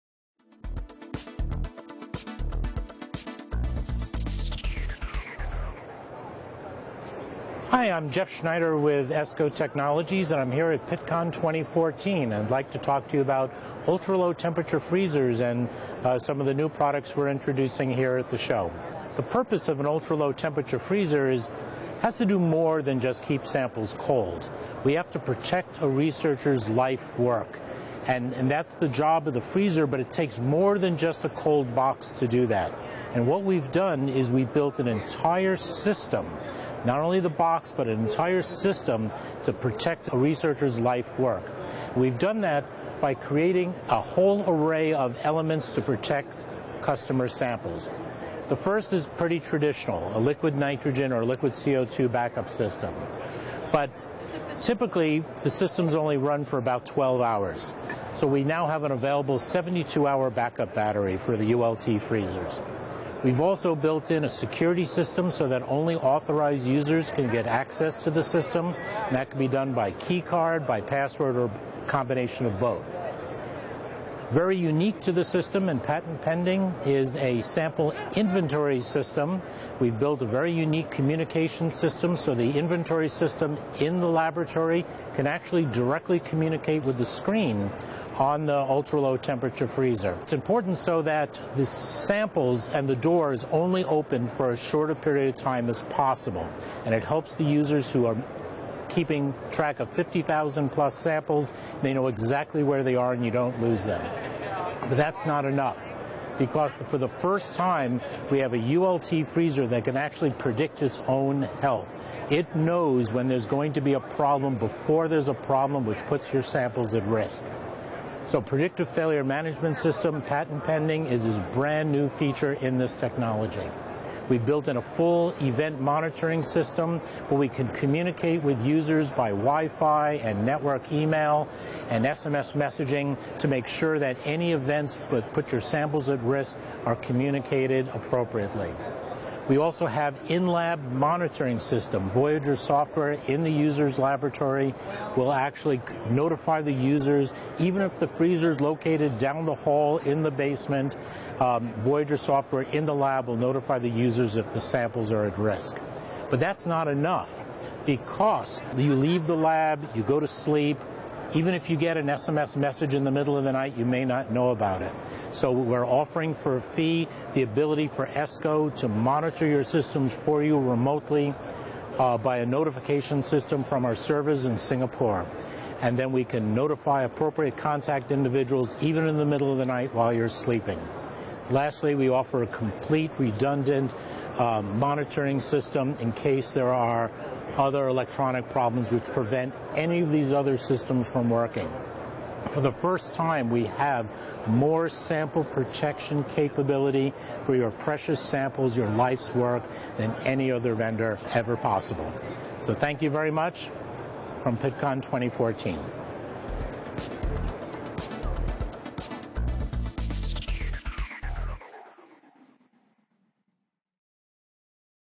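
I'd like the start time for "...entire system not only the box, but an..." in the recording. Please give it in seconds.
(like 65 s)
34 s.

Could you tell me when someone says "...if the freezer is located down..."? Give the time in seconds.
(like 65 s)
147 s.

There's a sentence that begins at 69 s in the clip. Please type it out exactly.
And that can be done by key card, by password, or combination of both.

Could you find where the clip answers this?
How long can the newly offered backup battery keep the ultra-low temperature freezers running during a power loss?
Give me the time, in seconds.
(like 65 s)
59 s.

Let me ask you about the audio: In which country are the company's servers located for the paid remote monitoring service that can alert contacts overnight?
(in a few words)
Singapore.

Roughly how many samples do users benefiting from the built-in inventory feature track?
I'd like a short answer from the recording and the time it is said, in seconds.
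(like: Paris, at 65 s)
50,000, at 99 s.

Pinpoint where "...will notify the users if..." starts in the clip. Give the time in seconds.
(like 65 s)
153 s.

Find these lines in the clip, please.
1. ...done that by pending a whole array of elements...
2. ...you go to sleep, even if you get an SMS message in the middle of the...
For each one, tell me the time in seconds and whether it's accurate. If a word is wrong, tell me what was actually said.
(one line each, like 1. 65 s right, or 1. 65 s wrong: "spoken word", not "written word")
1. 42 s wrong: "creating", not "pending"
2. 159 s right.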